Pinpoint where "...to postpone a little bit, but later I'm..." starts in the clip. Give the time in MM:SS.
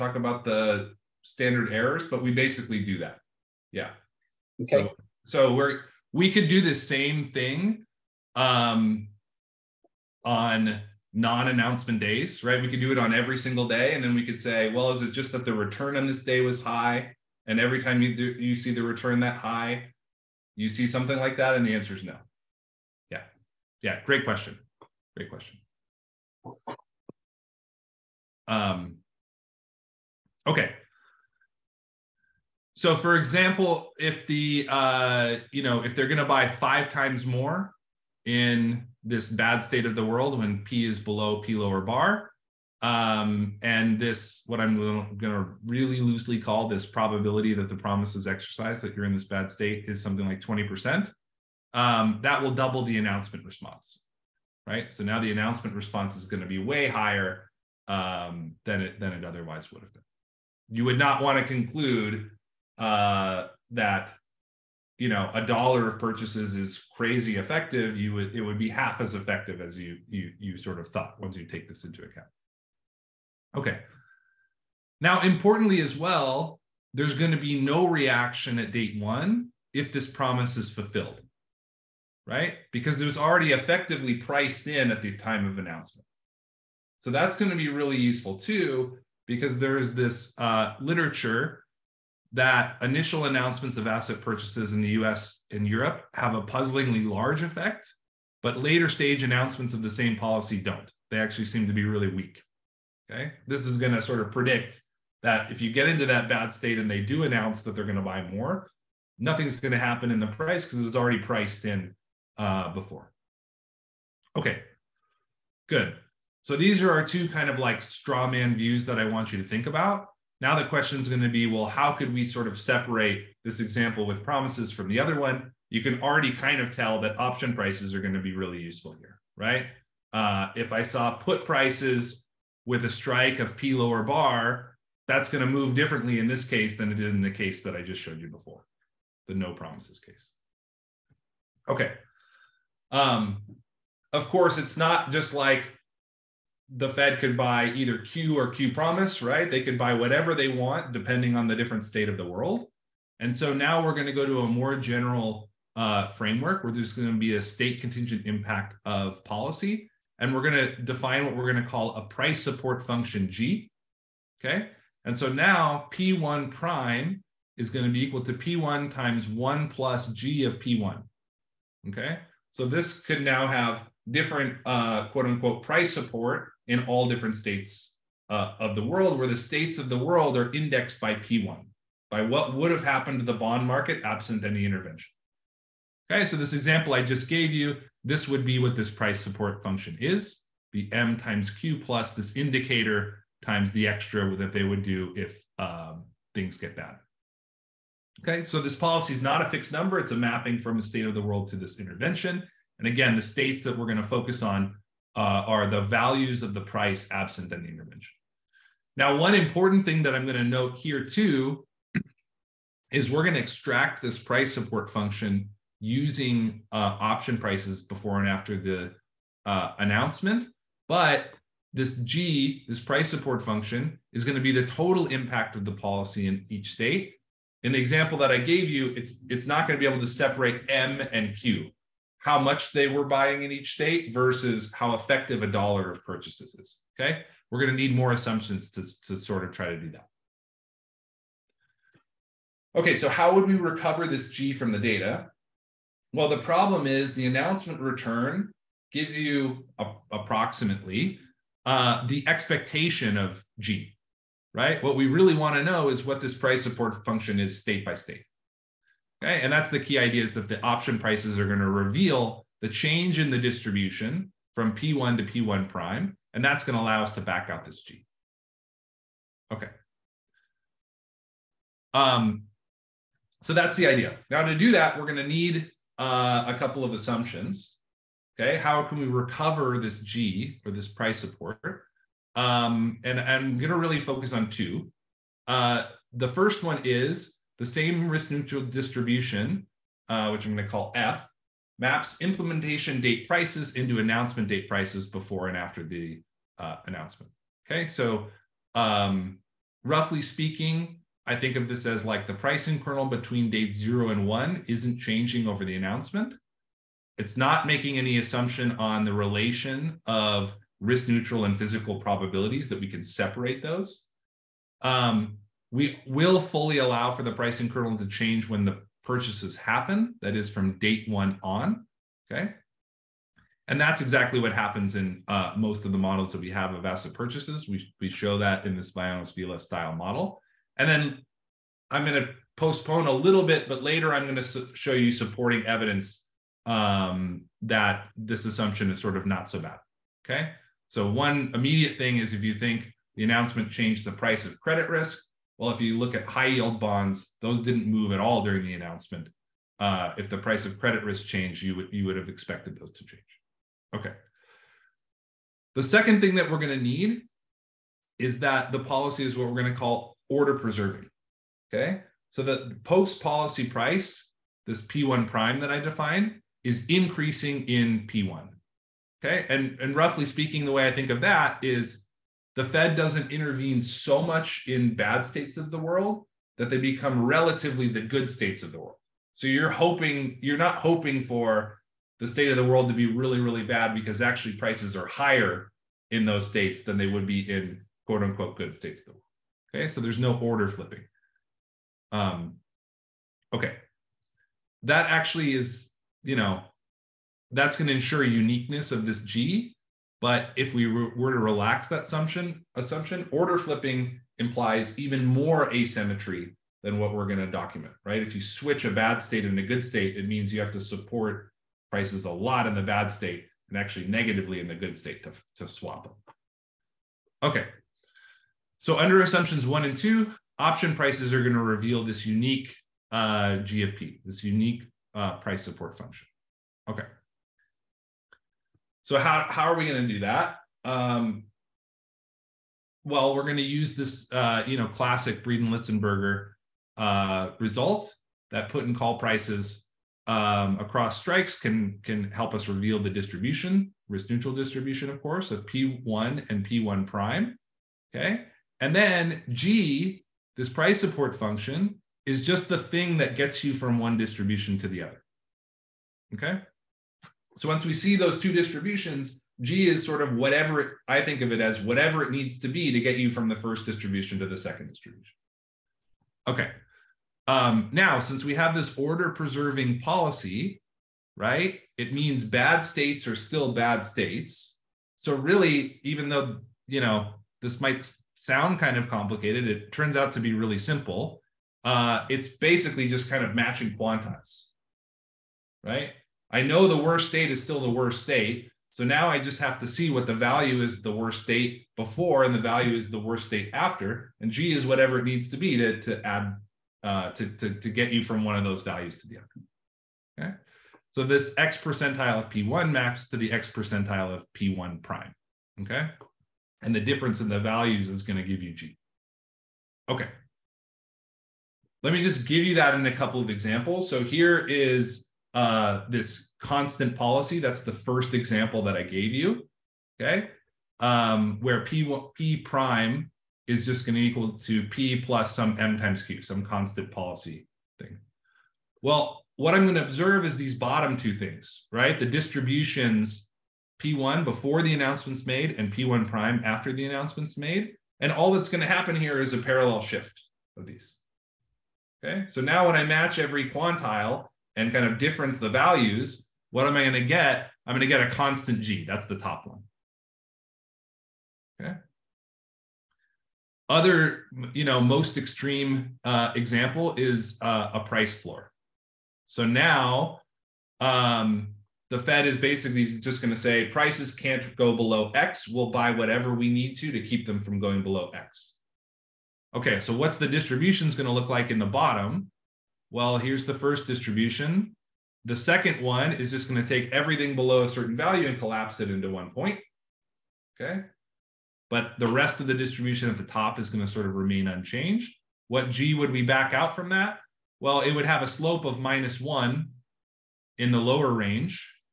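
05:32.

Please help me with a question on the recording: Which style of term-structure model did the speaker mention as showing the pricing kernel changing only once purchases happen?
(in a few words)
Vayanos Vila.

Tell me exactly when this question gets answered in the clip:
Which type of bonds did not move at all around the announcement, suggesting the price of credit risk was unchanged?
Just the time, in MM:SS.
05:46.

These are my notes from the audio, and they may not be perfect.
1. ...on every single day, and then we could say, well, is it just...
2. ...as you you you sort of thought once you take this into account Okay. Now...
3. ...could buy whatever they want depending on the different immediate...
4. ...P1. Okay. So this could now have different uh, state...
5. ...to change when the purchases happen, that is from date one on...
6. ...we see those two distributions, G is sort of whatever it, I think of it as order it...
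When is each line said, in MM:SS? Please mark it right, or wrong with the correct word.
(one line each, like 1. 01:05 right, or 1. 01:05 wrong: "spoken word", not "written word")
1. 00:12 right
2. 01:09 right
3. 02:29 wrong: "state", not "immediate"
4. 02:50 wrong: "quote", not "state"
5. 05:17 right
6. 07:37 wrong: "whatever", not "order".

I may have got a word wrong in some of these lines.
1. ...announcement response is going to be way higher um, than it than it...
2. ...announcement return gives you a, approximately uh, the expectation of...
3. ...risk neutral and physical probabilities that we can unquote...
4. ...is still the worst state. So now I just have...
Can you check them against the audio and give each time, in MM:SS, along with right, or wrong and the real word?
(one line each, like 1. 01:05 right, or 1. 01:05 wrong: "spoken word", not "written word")
1. 00:55 right
2. 04:07 right
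3. 05:10 wrong: "separate", not "unquote"
4. 08:07 right.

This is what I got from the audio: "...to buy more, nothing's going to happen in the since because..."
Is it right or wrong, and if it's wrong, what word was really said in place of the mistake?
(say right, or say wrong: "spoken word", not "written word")
wrong: "price", not "since".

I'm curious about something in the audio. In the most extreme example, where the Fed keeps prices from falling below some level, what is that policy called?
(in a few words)
A price floor.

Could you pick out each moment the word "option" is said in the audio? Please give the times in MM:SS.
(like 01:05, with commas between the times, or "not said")
02:07, 03:36, 04:20, 07:00.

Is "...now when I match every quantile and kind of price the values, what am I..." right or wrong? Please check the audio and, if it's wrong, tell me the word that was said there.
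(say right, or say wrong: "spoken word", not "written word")
wrong: "difference", not "price".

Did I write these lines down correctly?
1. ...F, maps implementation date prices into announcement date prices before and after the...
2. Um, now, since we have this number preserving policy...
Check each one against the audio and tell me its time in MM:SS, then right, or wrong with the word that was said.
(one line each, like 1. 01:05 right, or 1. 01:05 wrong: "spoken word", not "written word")
1. 04:50 right
2. 07:47 wrong: "order", not "number".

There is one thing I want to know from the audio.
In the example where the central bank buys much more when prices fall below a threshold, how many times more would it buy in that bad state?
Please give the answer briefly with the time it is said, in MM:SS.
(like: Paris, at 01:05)
5 times, at 00:36.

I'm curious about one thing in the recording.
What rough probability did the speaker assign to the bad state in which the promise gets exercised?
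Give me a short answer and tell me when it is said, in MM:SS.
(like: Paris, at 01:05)
20%, at 00:50.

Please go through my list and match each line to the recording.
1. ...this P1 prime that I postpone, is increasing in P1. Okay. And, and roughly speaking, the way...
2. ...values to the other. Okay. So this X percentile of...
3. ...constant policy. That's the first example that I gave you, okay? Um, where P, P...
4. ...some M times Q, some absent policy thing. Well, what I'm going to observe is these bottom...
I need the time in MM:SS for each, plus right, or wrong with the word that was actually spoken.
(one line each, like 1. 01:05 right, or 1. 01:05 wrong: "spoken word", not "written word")
1. 06:04 wrong: "define", not "postpone"
2. 08:18 right
3. 08:36 right
4. 08:45 wrong: "constant", not "absent".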